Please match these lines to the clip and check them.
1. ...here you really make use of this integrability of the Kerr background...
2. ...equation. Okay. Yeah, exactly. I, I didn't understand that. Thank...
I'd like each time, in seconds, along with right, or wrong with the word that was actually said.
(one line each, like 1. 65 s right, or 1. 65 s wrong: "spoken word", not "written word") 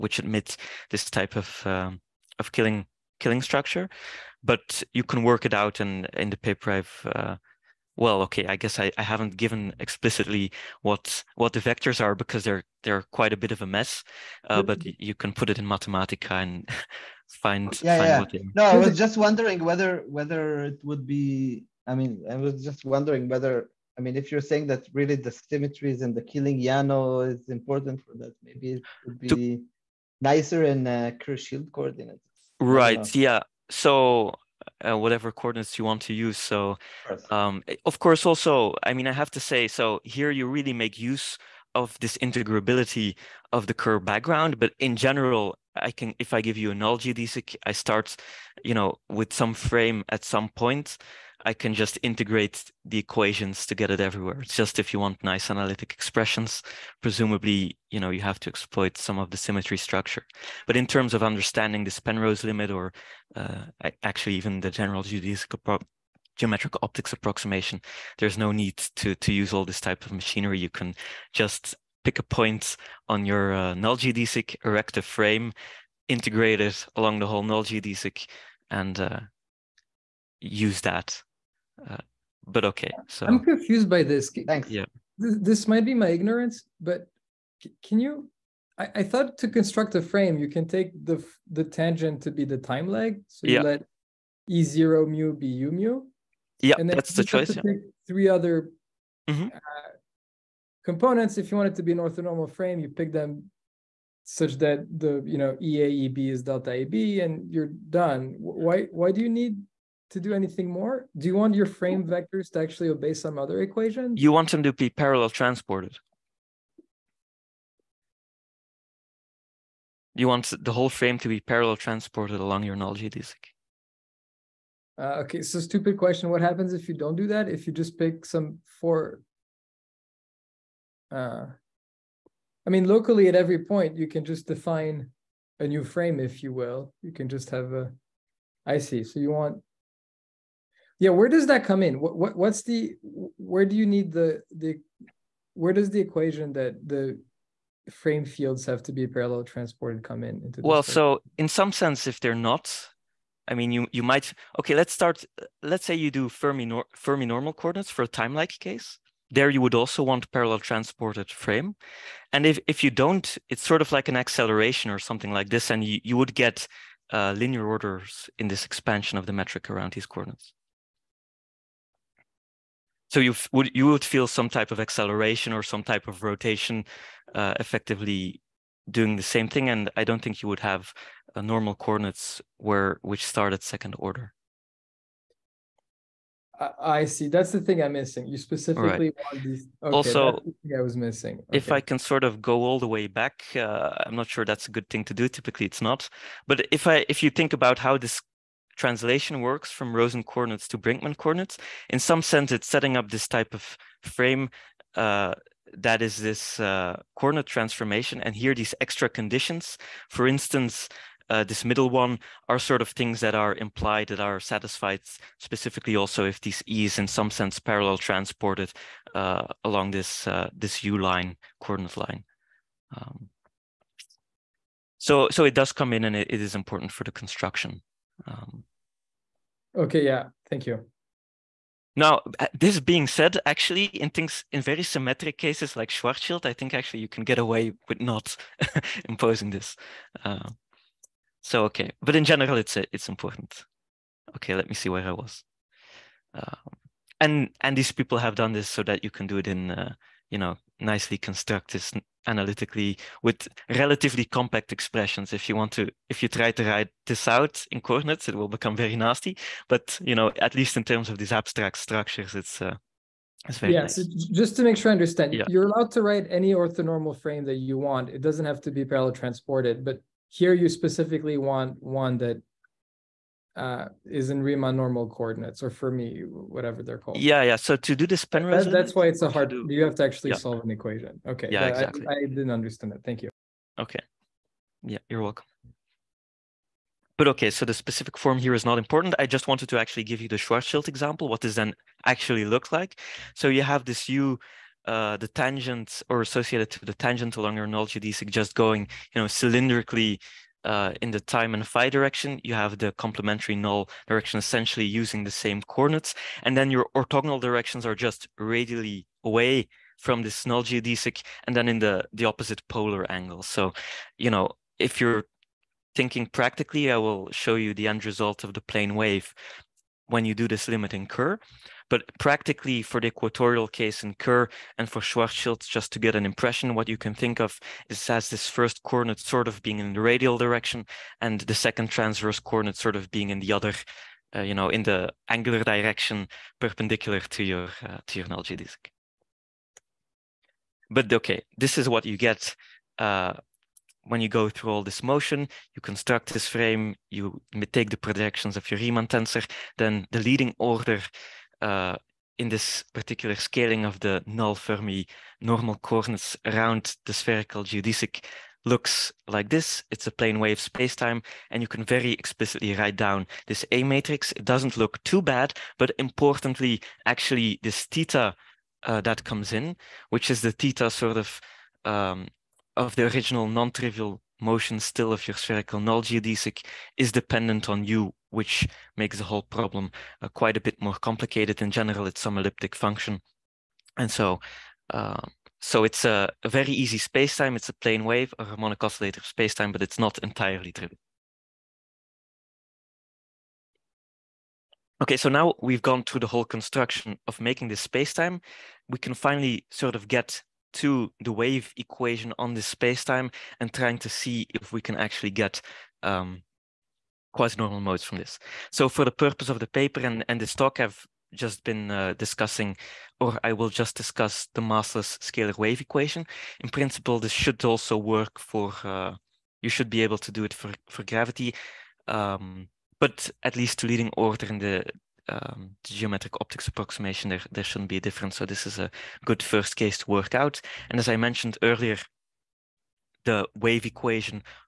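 1. 40 s right
2. 280 s right.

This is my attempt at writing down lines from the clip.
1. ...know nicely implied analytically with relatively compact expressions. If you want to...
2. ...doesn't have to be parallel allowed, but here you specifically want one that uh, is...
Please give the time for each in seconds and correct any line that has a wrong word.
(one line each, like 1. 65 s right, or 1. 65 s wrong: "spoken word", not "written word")
1. 250 s wrong: "constructed", not "implied"
2. 268 s wrong: "transported", not "allowed".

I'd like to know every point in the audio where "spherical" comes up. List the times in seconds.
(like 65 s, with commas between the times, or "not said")
357 s, 375 s.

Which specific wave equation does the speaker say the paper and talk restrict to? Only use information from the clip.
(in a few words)
massless scalar wave equation.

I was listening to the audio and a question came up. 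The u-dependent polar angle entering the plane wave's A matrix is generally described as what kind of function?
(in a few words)
elliptic function.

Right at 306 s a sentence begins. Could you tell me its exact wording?
And then your orthogonal directions are just radially away from this null geodesic and then in the, the opposite polar angle.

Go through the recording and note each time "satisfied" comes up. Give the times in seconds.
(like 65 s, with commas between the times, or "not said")
214 s.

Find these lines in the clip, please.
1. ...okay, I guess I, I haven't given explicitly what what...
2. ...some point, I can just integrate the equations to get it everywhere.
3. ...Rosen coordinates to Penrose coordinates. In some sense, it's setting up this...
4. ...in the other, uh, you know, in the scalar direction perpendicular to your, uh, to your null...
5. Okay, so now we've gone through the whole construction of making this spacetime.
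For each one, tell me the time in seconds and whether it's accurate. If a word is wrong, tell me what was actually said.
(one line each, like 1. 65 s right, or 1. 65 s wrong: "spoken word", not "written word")
1. 8 s right
2. 50 s right
3. 199 s wrong: "Brinkmann", not "Penrose"
4. 333 s wrong: "angular", not "scalar"
5. 395 s right.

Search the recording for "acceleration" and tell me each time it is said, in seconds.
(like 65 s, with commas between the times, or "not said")
164 s, 174 s.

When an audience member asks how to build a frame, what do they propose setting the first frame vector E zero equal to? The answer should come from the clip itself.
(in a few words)
U mu.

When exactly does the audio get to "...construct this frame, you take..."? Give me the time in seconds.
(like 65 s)
345 s.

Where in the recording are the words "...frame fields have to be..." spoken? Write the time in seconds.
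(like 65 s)
147 s.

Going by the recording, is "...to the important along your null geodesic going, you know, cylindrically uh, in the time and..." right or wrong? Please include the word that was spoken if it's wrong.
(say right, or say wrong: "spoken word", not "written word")
wrong: "tangent", not "important".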